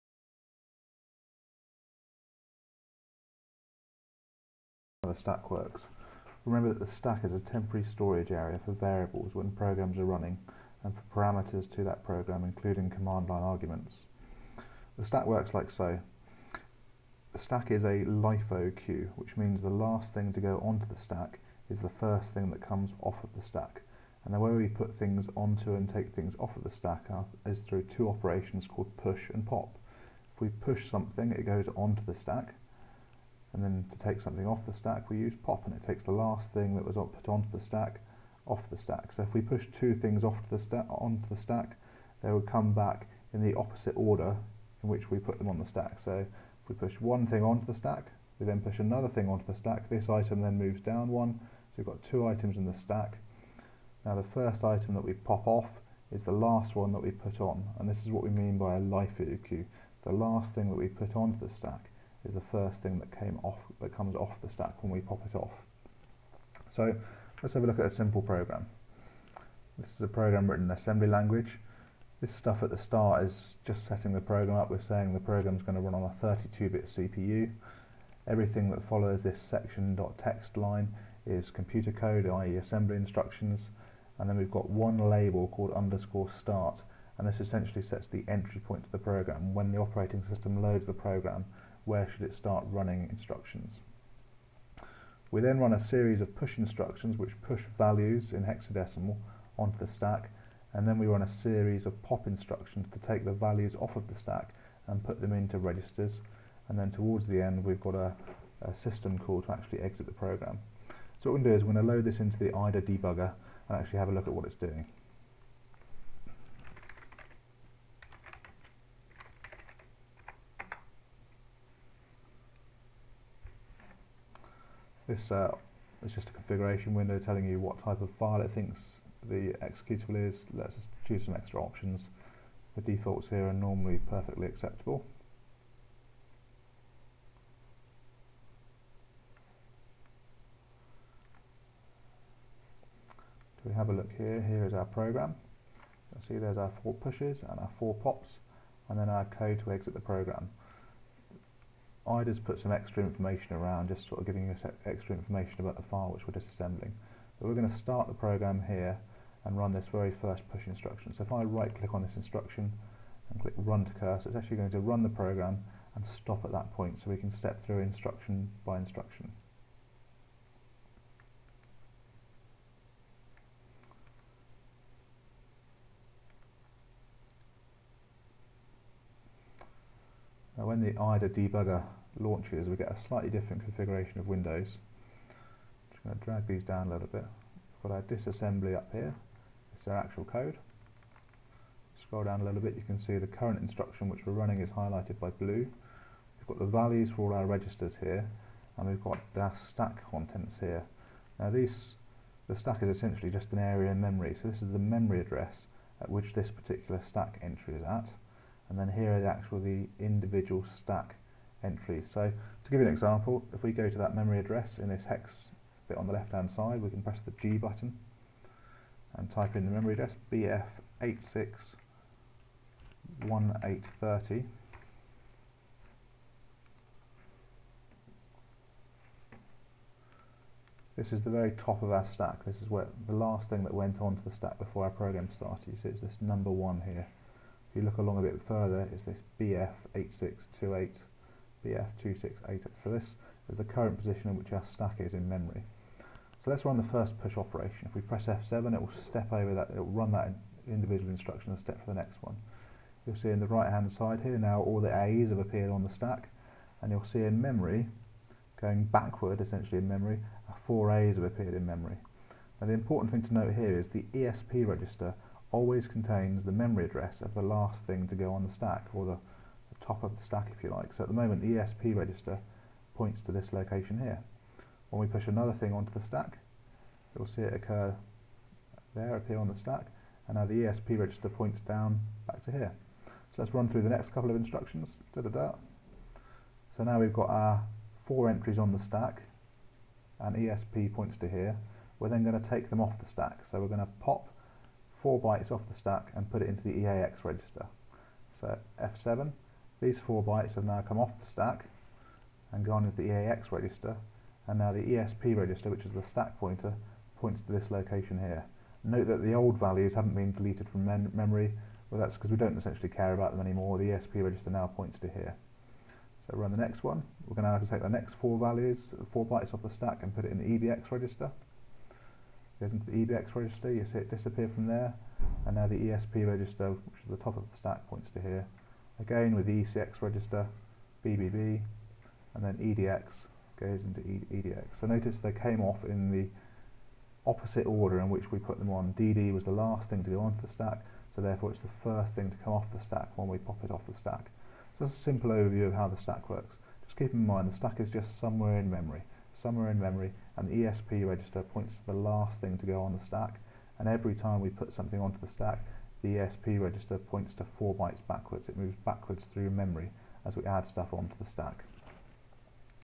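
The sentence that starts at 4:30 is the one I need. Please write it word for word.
So at the moment the ESP register points to this location here.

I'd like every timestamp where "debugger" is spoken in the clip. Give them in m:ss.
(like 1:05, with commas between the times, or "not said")
1:52, 3:01.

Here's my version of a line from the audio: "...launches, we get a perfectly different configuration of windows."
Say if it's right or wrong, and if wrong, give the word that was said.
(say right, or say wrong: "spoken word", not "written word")
wrong: "slightly", not "perfectly".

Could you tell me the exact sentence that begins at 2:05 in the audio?
this uh, is just a configuration window telling you what type of file it thinks the executable is.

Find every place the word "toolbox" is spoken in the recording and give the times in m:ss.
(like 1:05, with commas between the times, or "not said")
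not said.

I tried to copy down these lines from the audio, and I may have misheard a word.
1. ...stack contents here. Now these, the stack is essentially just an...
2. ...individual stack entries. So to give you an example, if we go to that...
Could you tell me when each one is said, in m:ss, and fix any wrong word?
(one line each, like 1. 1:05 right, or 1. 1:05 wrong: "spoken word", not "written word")
1. 3:19 right
2. 3:29 right.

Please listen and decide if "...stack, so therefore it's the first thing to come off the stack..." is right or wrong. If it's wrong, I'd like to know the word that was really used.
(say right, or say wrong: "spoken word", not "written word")
right.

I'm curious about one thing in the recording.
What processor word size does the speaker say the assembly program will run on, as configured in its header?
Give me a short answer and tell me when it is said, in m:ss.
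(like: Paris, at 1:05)
32-bit, at 1:16.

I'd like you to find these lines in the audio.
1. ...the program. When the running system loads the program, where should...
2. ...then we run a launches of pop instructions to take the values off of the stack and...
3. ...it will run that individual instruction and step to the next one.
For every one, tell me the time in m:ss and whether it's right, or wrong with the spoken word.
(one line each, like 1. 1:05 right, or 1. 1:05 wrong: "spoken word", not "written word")
1. 1:28 wrong: "operating", not "running"
2. 1:40 wrong: "series", not "launches"
3. 4:09 right.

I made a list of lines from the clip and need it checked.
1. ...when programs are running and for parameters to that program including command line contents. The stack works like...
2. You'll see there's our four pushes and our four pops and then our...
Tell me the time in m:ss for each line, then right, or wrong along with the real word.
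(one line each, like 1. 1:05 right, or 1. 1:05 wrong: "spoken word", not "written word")
1. 0:09 wrong: "arguments", not "contents"
2. 2:26 right.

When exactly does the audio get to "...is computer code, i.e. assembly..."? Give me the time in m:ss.
1:21.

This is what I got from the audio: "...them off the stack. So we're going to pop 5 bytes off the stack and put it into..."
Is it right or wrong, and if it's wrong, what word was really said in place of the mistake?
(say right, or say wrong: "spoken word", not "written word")
wrong: "4", not "5".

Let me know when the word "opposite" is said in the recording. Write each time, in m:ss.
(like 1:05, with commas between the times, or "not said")
0:43, 5:37.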